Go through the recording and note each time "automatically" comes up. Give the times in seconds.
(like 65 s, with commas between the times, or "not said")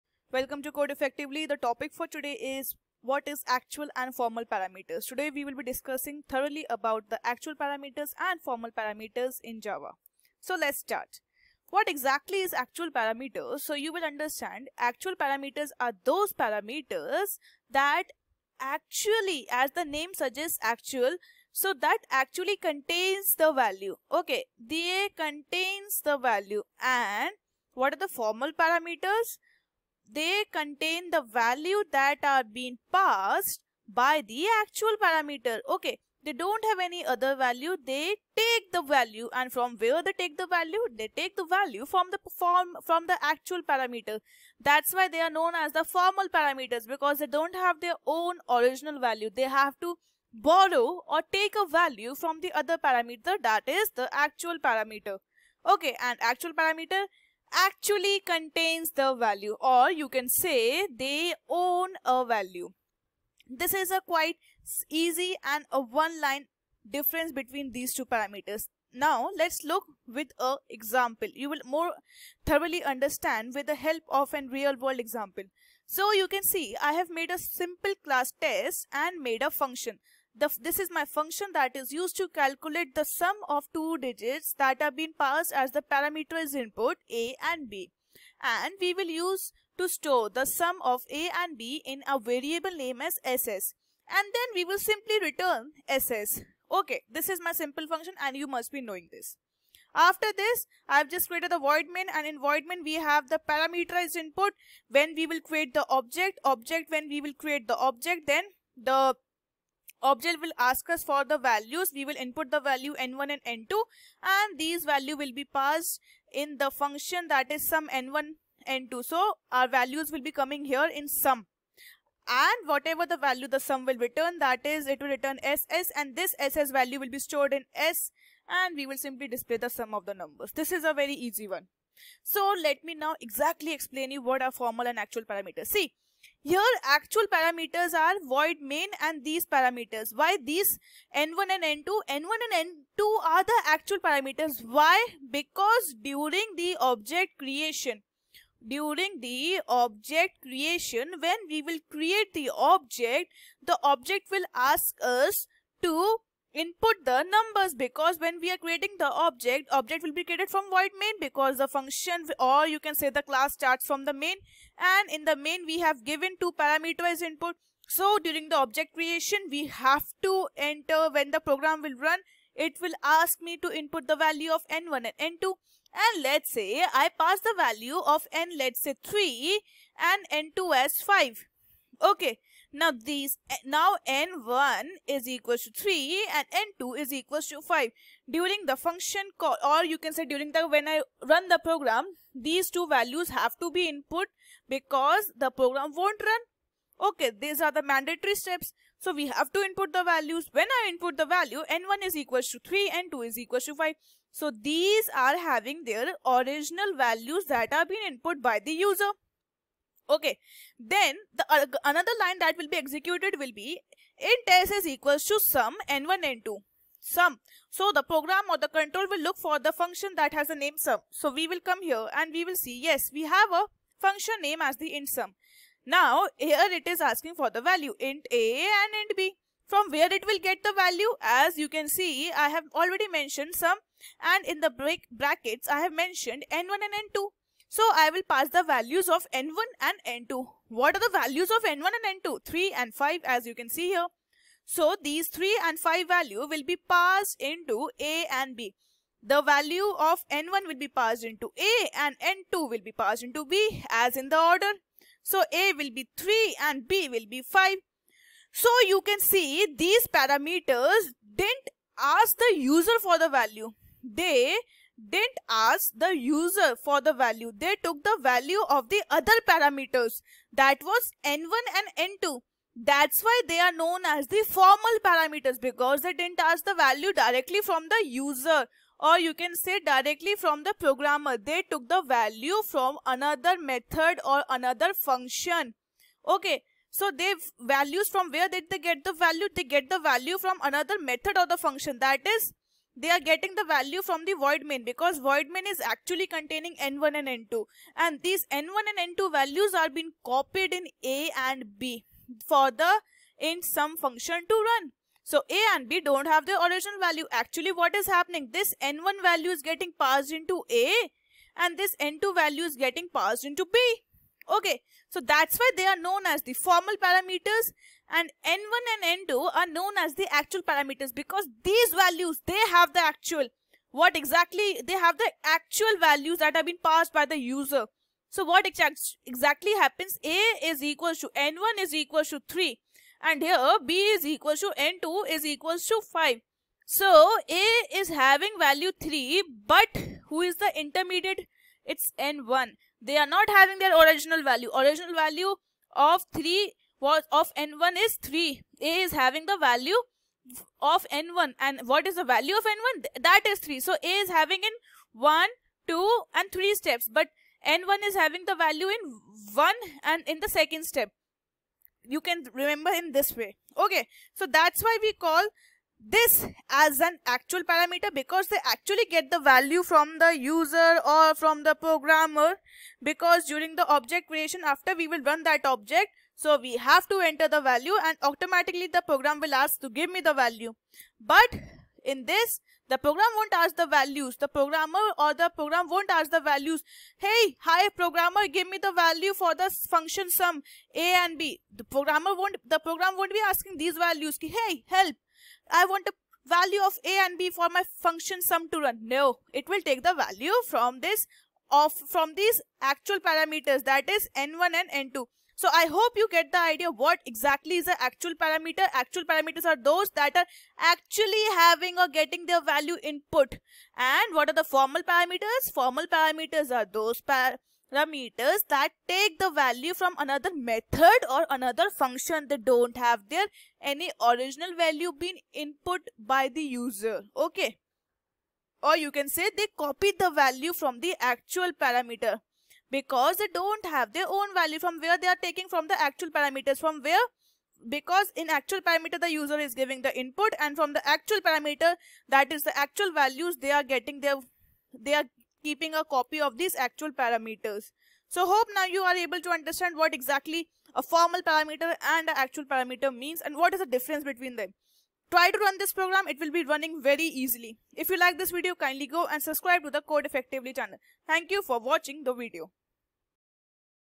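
378 s.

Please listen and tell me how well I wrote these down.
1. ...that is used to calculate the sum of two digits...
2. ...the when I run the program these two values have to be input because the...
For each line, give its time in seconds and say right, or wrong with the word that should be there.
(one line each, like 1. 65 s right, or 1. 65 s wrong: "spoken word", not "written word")
1. 81 s right
2. 190 s right.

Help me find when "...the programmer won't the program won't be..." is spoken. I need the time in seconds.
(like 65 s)
391 s.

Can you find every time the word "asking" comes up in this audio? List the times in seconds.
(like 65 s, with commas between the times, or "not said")
226 s, 393 s.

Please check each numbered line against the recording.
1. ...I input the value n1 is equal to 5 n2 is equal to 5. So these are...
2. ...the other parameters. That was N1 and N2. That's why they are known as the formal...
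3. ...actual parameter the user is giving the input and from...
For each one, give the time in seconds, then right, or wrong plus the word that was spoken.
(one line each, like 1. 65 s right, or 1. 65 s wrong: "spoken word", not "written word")
1. 200 s wrong: "3", not "5"
2. 268 s right
3. 438 s right.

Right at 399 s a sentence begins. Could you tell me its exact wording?
No, it will take the value from this of from these actual parameters that is n1 and n2.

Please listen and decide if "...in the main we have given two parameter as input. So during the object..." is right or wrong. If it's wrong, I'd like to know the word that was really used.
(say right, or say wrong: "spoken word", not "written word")
right.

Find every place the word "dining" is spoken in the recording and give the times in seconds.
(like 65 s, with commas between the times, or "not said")
not said.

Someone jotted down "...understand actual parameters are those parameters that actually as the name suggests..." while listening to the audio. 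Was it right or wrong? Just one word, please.
right.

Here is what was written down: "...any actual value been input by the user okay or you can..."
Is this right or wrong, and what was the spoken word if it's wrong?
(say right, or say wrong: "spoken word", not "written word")
wrong: "original", not "actual".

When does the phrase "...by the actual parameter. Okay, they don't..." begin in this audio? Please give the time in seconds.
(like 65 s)
33 s.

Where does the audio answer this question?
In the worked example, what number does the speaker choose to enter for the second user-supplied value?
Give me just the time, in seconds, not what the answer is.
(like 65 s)
180 s.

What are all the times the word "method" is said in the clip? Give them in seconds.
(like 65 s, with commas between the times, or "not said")
283 s, 291 s, 420 s.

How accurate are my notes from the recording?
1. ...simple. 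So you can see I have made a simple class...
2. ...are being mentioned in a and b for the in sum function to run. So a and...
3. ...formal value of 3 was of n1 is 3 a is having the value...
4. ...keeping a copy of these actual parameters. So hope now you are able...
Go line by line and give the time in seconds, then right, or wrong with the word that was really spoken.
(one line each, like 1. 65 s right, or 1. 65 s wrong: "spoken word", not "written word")
1. 74 s wrong: "example", not "simple"
2. 299 s wrong: "copied", not "mentioned"
3. 344 s wrong: "original", not "formal"
4. 445 s right.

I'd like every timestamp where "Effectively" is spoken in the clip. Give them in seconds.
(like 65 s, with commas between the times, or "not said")
0 s, 460 s.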